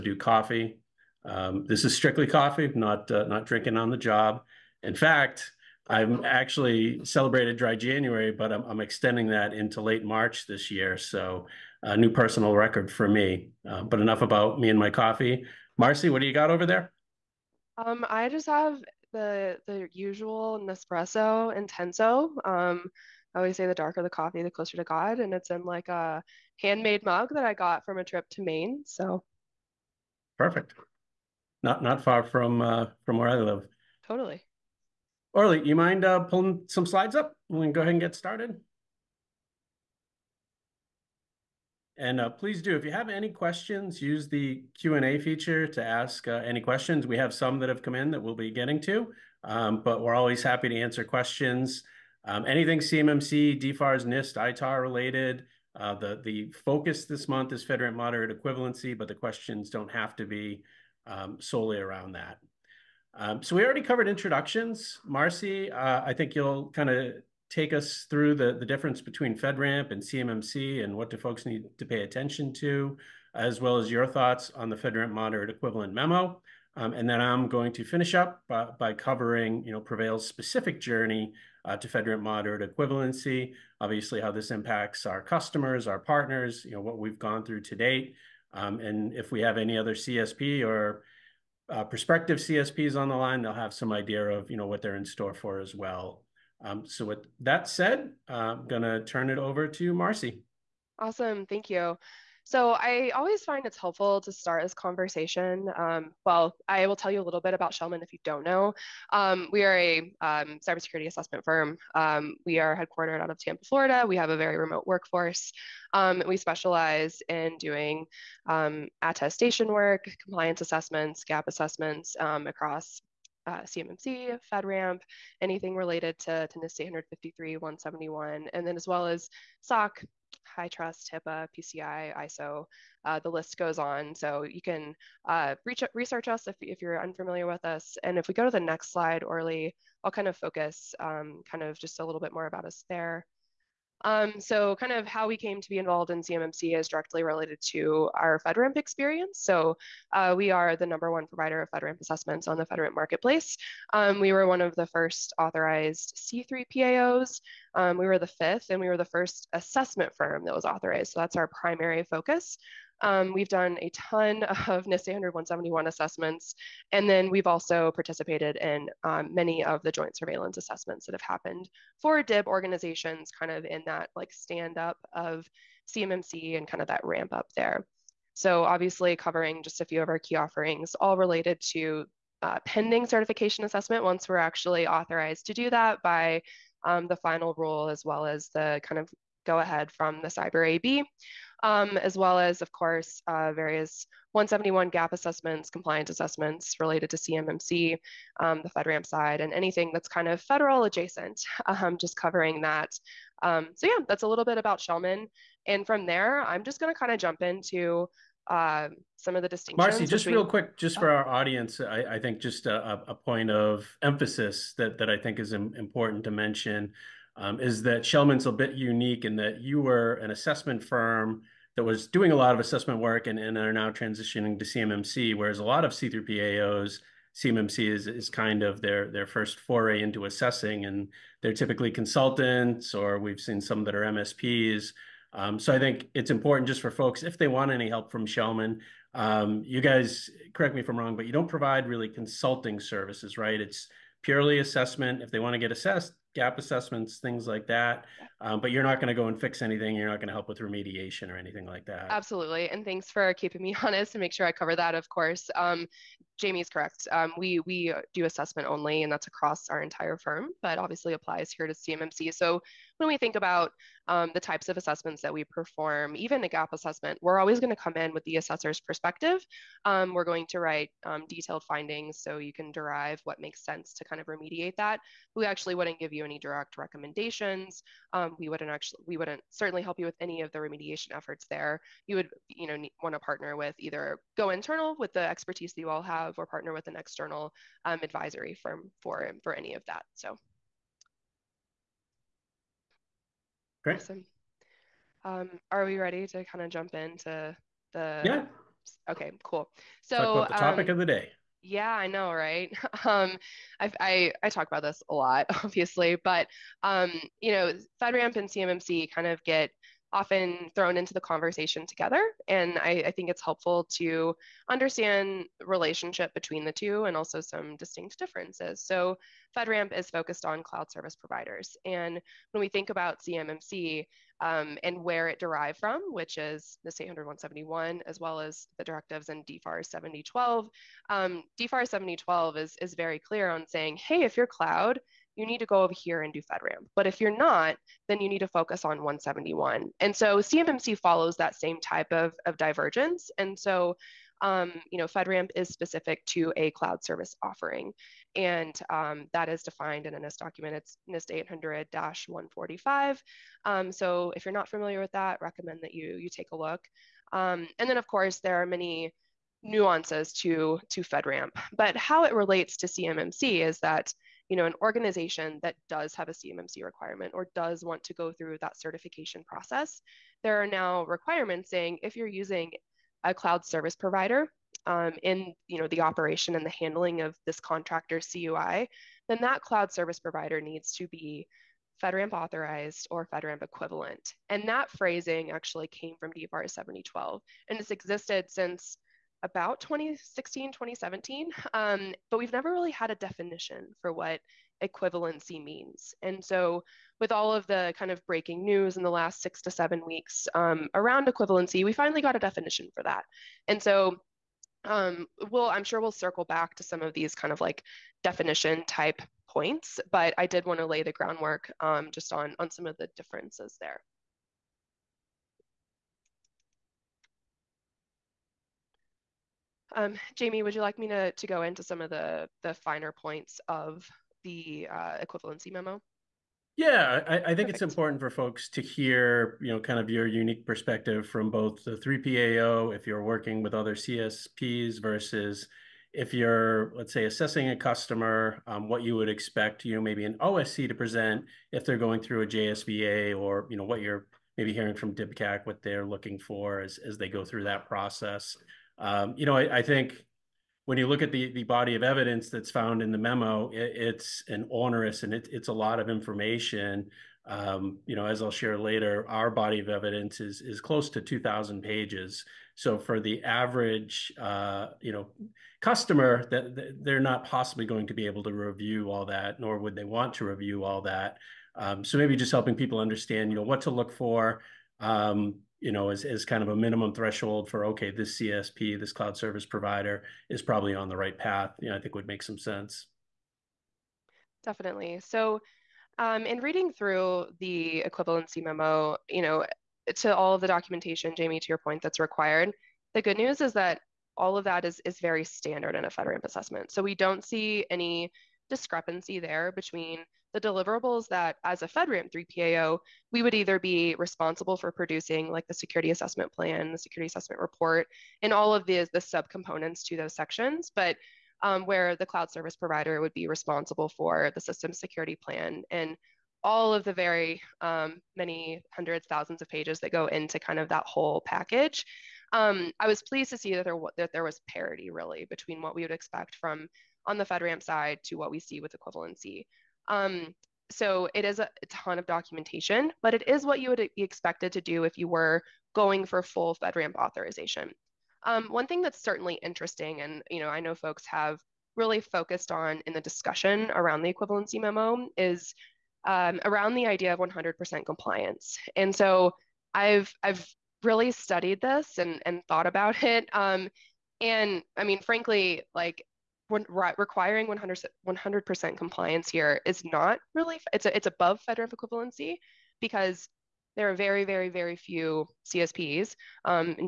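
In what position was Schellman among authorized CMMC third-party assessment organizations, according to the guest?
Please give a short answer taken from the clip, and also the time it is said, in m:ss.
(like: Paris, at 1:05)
fifth, at 2:38.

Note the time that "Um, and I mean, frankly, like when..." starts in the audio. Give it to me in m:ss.
9:13.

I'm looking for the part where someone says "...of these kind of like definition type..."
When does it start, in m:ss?
6:47.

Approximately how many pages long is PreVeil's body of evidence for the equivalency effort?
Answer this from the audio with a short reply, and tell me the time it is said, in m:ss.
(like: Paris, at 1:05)
2,000 pages, at 7:41.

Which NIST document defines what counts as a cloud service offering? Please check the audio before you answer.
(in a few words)
NIST 800-145.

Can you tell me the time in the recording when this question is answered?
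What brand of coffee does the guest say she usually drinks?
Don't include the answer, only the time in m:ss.
0:20.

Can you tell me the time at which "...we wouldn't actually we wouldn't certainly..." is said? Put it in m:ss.
4:38.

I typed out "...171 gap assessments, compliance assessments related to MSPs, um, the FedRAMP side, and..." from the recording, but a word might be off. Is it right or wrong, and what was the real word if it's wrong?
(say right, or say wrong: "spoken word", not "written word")
wrong: "CMMC", not "MSPs".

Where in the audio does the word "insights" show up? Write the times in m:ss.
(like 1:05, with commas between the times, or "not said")
not said.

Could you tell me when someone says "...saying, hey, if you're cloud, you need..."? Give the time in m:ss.
5:33.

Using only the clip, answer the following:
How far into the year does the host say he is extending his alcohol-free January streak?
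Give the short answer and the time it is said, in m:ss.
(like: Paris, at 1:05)
late March, at 0:09.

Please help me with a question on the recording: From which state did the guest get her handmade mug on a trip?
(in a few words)
Maine.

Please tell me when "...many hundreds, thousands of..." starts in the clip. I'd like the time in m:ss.
8:38.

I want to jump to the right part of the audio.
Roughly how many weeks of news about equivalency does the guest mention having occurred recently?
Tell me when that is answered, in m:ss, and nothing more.
6:39.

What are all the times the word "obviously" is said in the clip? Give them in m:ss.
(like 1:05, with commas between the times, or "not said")
1:23, 2:58, 4:20, 5:05.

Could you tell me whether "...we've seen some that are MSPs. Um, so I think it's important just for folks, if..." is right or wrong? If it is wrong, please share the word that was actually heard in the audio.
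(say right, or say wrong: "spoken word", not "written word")
right.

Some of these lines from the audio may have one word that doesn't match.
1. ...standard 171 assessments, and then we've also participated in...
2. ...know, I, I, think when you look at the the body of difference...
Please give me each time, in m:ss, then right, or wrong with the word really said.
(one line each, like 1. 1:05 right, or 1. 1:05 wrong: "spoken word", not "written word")
1. 2:45 right
2. 7:29 wrong: "evidence", not "difference".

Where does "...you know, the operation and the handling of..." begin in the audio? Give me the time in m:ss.
6:15.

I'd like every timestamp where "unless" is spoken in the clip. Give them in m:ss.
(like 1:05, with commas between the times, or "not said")
not said.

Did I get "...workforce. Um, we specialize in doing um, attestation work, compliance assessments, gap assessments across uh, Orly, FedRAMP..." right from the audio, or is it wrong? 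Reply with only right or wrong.
wrong.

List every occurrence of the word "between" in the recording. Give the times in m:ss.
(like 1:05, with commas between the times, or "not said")
1:09, 3:30, 5:16, 8:19, 8:45.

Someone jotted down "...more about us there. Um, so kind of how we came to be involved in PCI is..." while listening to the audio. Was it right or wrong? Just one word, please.
wrong.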